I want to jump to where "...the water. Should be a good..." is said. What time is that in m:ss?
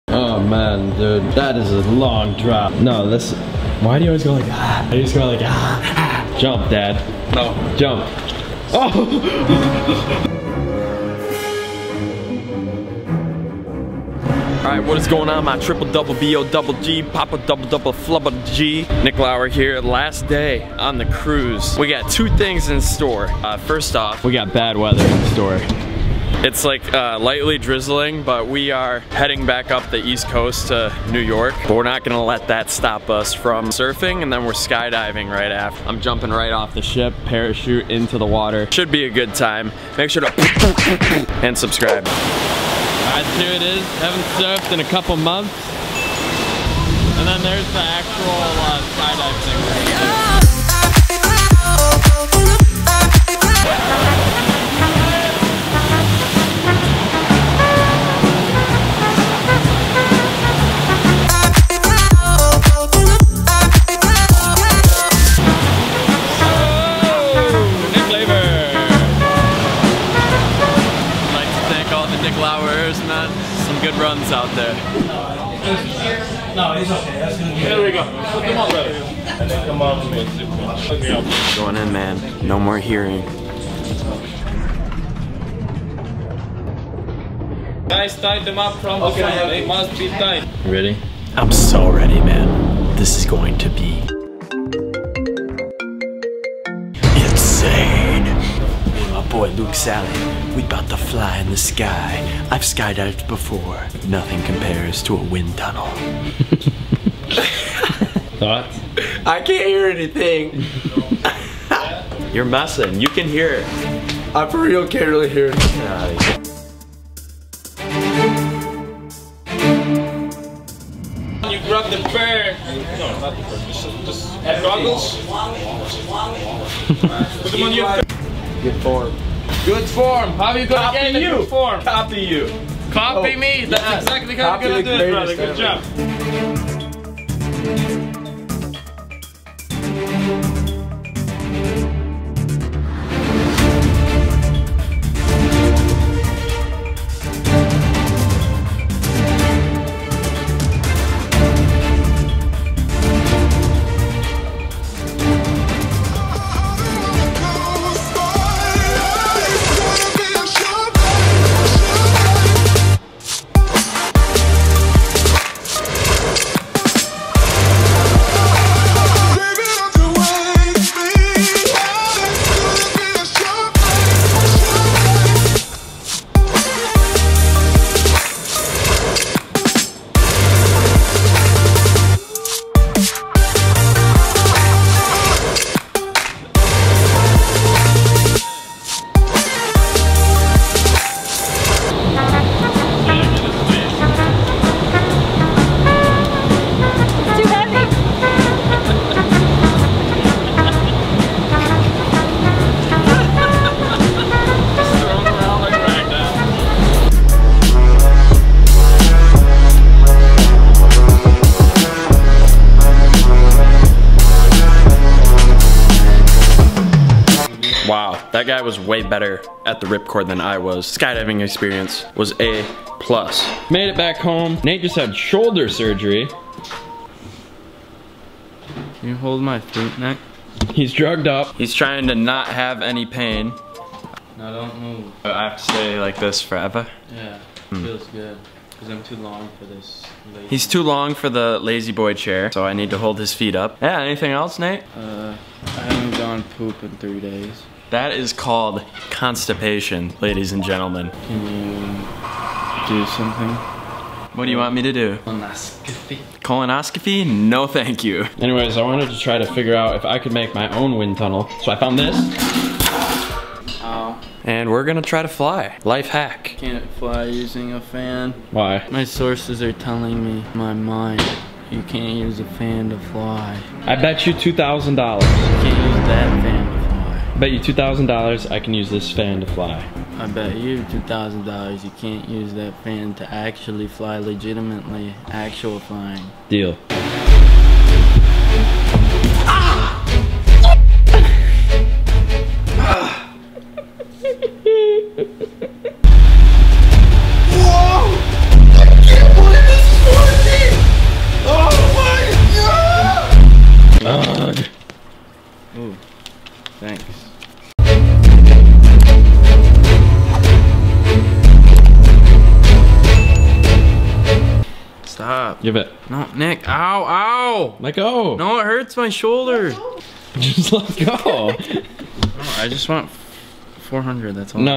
0:38.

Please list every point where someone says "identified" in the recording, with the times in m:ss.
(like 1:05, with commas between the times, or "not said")
not said.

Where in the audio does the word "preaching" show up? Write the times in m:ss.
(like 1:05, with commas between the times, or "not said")
not said.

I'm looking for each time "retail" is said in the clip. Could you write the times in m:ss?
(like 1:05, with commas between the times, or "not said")
not said.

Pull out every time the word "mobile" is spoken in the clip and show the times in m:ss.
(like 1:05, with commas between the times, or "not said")
not said.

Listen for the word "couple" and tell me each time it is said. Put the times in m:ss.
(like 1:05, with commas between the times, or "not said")
0:44.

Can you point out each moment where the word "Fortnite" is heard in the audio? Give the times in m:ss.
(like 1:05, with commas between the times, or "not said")
not said.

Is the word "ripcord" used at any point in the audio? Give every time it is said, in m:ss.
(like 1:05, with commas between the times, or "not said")
3:39.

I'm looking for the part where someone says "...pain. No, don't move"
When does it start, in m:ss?
3:53.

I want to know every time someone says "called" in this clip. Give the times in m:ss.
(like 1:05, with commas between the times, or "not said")
4:08.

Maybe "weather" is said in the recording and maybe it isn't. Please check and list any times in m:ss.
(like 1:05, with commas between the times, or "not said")
0:24.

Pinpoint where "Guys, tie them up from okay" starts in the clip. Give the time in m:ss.
1:27.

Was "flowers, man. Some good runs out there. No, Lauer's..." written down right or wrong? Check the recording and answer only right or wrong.
wrong.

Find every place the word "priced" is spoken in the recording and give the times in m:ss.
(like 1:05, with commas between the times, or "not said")
not said.